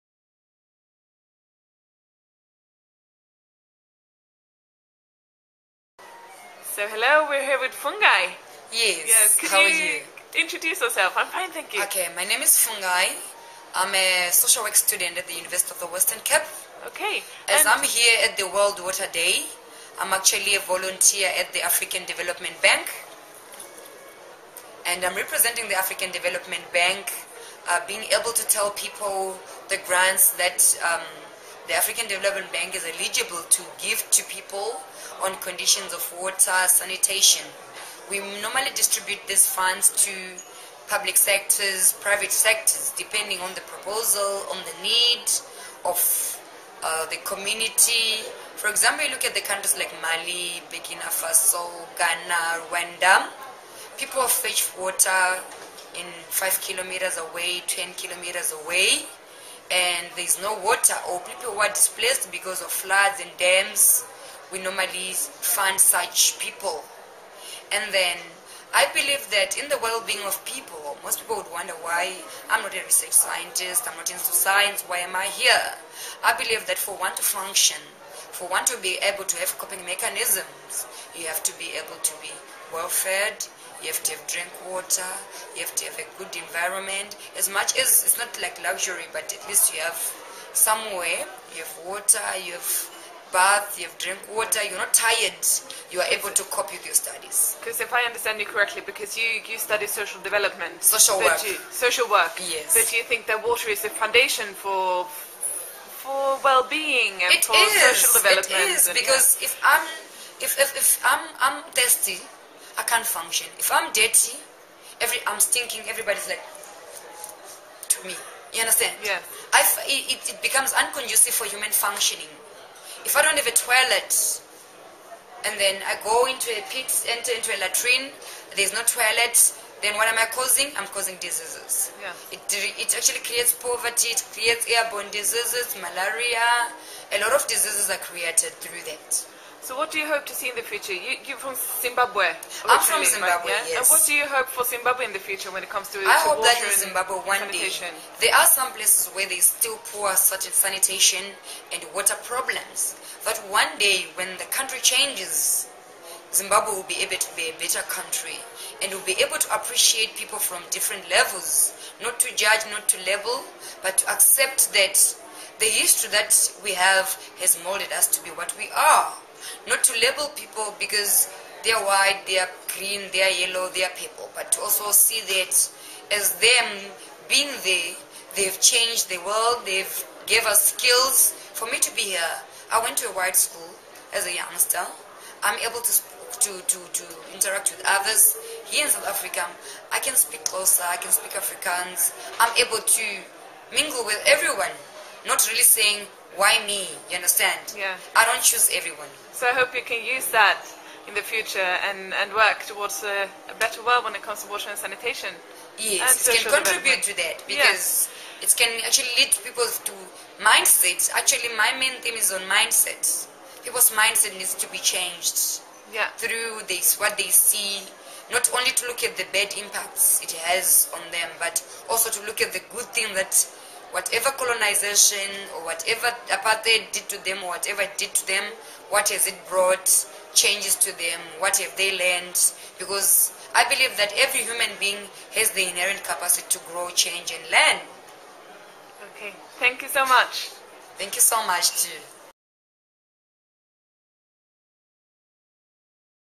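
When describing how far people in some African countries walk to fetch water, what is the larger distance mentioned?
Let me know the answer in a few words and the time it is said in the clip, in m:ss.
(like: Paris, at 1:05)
10 kilometers, at 0:57.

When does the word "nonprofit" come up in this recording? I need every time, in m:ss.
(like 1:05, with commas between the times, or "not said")
not said.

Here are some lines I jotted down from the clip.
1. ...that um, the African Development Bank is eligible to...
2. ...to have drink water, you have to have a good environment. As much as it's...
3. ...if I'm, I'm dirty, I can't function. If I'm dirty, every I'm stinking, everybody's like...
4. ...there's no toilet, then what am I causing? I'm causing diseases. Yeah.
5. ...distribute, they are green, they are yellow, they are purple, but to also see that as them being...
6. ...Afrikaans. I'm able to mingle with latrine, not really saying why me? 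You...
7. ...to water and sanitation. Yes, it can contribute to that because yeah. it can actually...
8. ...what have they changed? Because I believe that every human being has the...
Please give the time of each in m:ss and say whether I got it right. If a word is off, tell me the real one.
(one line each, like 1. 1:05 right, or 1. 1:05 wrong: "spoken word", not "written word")
1. 0:30 right
2. 1:24 right
3. 1:50 wrong: "thirsty", not "dirty"
4. 2:08 right
5. 2:51 wrong: "white", not "distribute"
6. 3:11 wrong: "everyone", not "latrine"
7. 3:24 right
8. 3:51 wrong: "learned", not "changed".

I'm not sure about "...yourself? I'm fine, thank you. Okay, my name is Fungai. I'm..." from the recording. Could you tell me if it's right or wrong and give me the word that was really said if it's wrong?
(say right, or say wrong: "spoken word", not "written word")
right.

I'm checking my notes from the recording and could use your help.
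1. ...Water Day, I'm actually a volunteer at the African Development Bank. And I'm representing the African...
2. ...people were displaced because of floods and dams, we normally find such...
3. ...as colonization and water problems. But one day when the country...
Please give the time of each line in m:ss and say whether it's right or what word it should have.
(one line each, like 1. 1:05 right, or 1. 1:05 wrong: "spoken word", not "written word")
1. 0:18 right
2. 1:01 right
3. 2:30 wrong: "sanitation", not "colonization".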